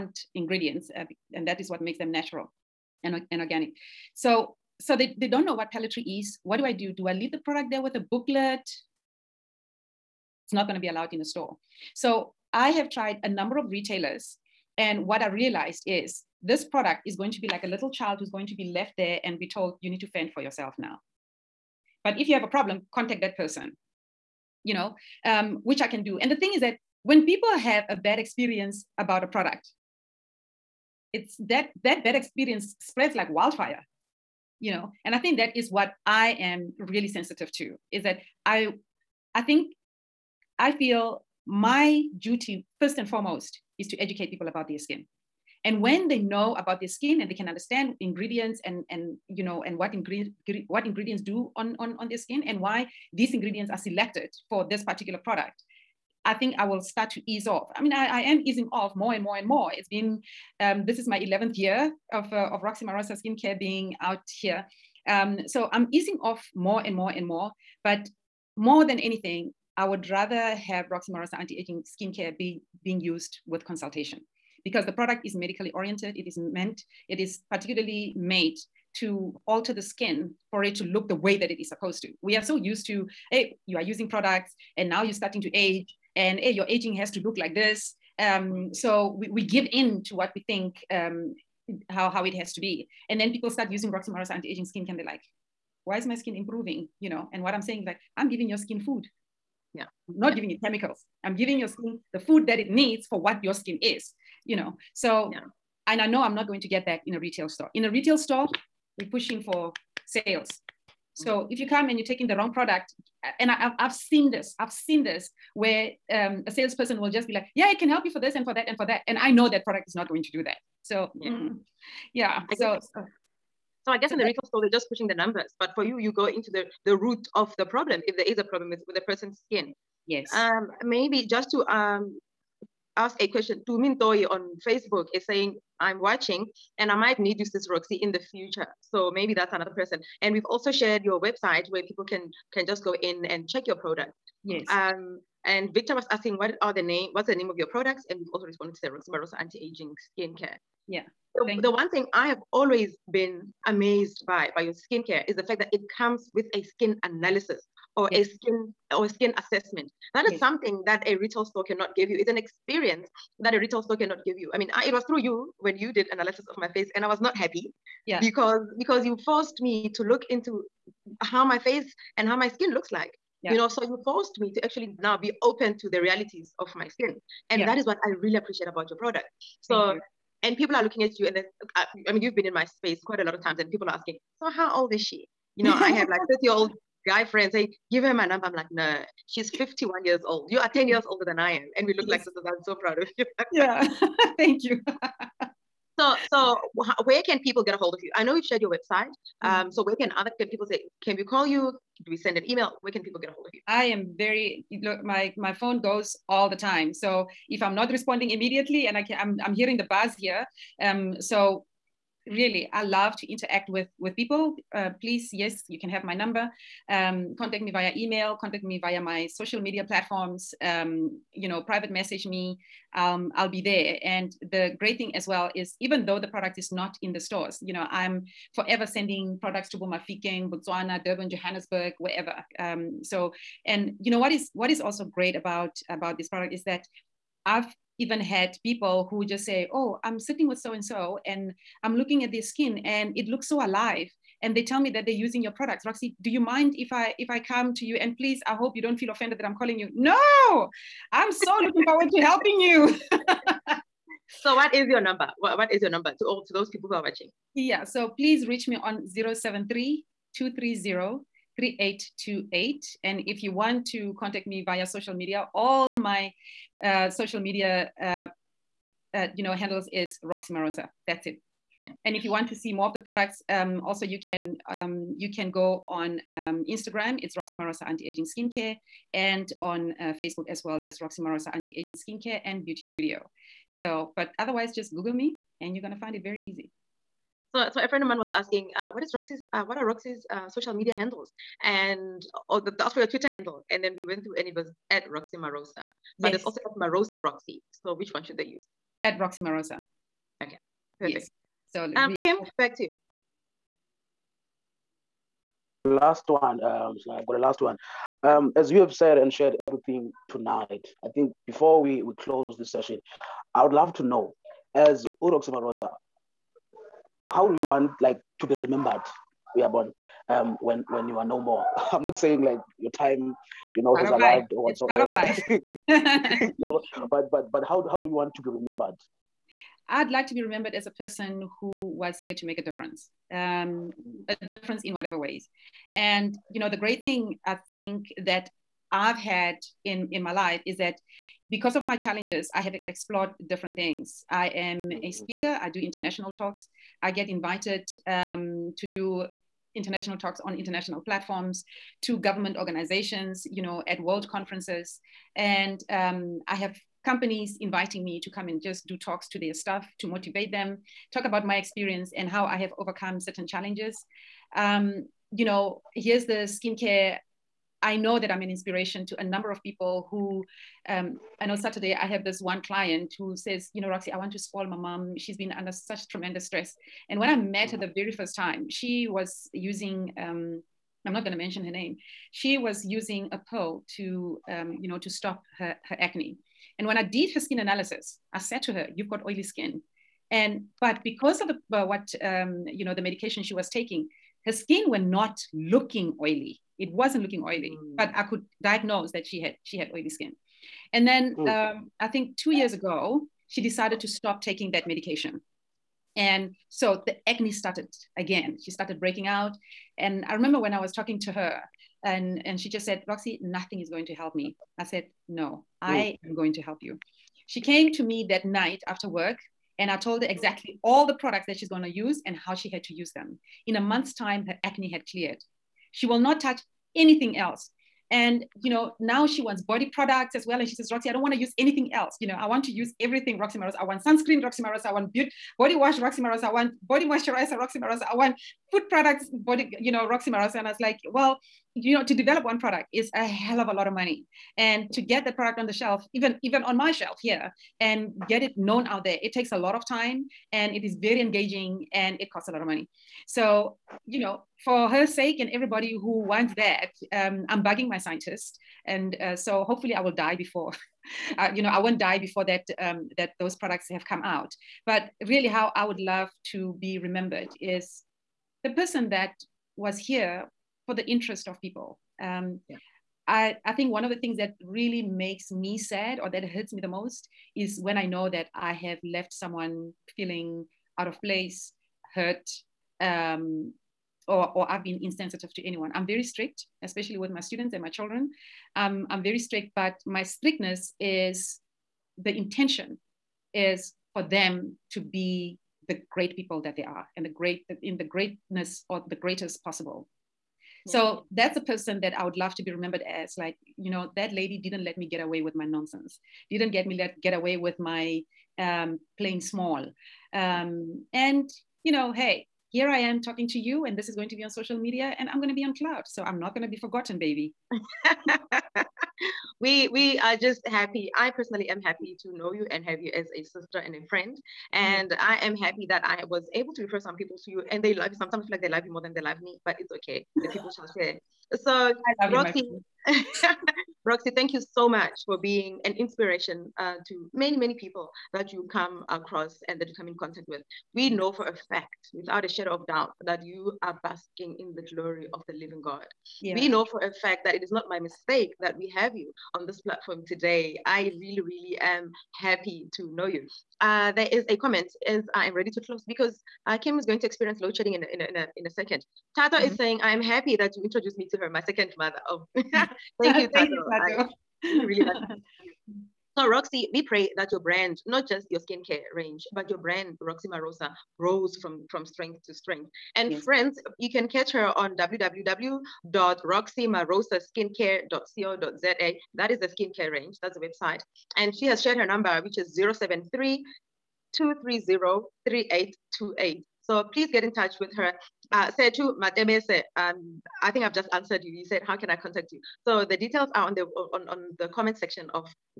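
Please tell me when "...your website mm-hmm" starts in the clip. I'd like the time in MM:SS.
03:18.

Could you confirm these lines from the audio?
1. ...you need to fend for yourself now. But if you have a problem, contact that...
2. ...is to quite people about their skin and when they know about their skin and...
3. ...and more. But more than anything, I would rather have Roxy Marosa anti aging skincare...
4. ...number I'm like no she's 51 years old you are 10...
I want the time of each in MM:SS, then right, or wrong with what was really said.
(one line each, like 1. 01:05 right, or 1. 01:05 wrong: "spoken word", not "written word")
1. 00:19 right
2. 00:43 wrong: "educate", not "quite"
3. 01:07 right
4. 03:08 right.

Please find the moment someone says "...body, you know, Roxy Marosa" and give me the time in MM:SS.
07:19.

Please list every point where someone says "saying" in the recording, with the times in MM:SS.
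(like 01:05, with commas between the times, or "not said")
01:37, 02:15, 05:22, 09:19.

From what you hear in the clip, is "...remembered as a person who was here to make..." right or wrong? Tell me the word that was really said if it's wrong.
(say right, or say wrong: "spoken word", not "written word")
right.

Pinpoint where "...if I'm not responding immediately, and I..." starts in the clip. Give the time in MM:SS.
03:27.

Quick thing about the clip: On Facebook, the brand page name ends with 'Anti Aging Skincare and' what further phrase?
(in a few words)
Beauty Studio.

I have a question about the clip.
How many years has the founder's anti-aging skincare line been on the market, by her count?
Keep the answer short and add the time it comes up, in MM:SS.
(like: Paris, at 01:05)
11th year, at 01:01.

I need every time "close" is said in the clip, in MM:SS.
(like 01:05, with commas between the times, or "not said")
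05:12, 09:15.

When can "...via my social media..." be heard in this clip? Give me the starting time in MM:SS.
03:38.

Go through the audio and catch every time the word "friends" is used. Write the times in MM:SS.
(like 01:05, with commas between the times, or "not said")
03:07, 04:47, 08:44, 09:33.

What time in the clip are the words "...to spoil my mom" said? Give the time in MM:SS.
06:14.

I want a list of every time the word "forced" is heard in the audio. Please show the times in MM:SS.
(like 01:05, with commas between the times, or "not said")
02:49, 02:54.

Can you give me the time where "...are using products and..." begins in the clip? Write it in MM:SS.
01:23.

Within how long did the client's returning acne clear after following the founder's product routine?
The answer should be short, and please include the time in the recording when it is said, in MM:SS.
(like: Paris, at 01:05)
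a month, at 07:03.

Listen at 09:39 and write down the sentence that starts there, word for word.
That is the skincare range, that's the website.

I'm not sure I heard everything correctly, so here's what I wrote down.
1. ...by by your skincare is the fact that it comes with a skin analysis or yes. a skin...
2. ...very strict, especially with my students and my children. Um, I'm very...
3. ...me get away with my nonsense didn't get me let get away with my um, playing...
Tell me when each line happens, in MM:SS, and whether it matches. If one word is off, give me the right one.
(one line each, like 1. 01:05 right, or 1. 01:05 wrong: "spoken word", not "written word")
1. 02:34 right
2. 08:06 right
3. 08:24 right.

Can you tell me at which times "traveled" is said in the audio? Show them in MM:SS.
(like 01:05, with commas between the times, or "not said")
not said.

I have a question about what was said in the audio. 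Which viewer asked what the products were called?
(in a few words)
Victor.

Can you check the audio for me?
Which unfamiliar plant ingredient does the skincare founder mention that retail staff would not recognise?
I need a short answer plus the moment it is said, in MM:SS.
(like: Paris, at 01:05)
pellitory, at 00:05.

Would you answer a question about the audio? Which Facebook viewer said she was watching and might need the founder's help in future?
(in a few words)
Tumin Toy.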